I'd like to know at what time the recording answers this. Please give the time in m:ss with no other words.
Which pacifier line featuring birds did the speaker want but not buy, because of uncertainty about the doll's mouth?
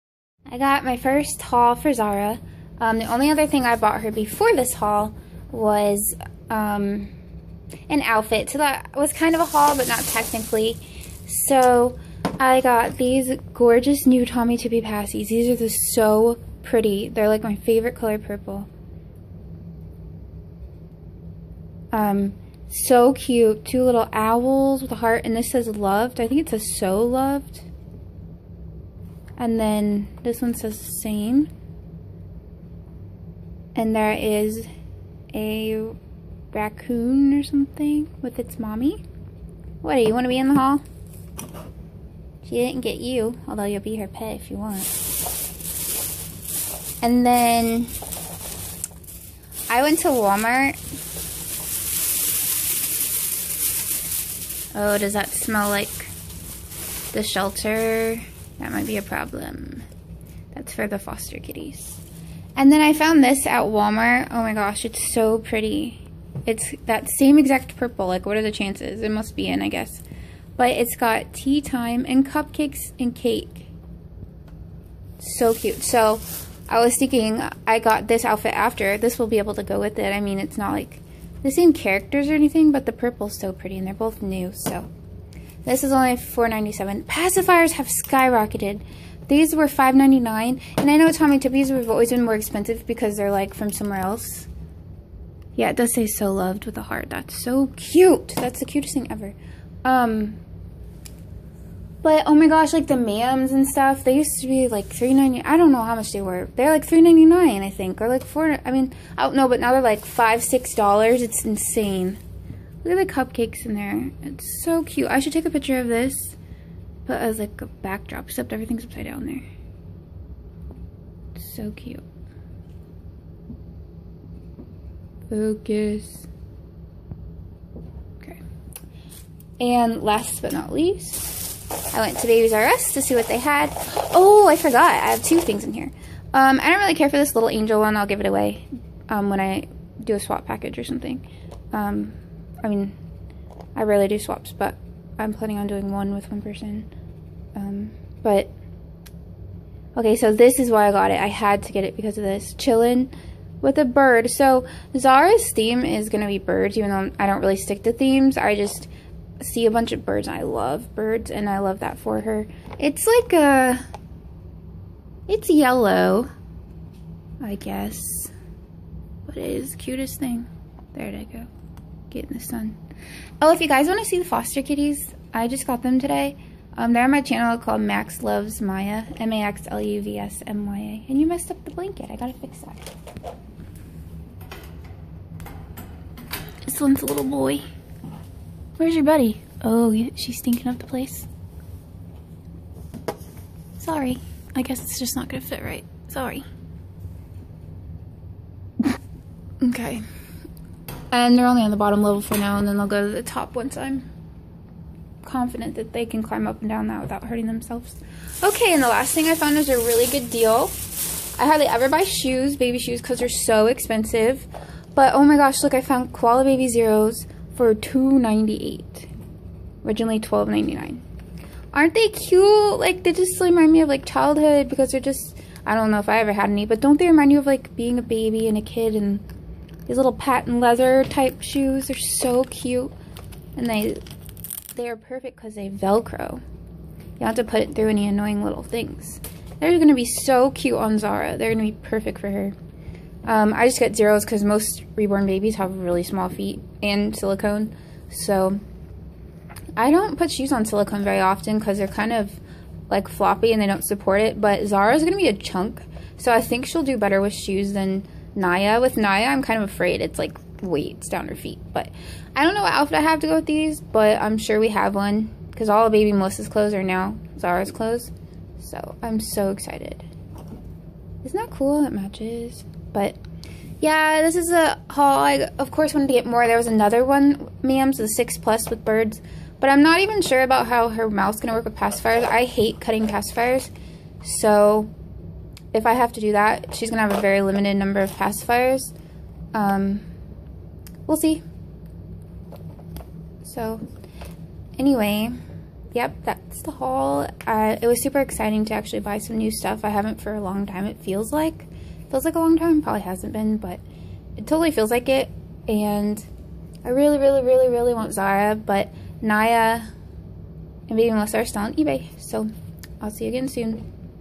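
4:37.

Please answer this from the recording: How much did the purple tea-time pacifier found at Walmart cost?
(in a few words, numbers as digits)
$4.97.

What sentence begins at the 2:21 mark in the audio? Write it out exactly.
Um, I mean, I rarely do swaps, but I'm planning on doing one with one person.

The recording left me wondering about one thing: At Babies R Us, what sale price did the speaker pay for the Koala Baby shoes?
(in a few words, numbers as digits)
$2.98.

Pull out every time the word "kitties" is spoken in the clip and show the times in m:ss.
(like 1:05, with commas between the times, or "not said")
1:01, 2:54.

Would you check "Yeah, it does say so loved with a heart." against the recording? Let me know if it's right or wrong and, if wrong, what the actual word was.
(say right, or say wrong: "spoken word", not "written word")
right.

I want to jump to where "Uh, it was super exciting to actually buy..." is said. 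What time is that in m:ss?
4:57.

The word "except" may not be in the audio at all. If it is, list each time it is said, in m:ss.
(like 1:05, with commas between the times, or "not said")
1:58.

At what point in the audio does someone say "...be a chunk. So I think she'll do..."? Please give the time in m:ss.
4:15.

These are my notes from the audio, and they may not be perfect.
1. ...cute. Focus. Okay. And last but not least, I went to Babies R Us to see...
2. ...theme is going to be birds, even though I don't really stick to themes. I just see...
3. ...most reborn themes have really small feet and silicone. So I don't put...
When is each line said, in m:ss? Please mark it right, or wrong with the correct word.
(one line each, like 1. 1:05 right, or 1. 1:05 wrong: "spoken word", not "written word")
1. 2:01 right
2. 2:35 right
3. 4:04 wrong: "babies", not "themes".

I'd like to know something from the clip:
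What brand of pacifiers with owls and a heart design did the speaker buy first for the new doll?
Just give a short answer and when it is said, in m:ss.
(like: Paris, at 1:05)
Tommee Tippee, at 0:14.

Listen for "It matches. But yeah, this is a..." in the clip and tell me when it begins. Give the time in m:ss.
4:31.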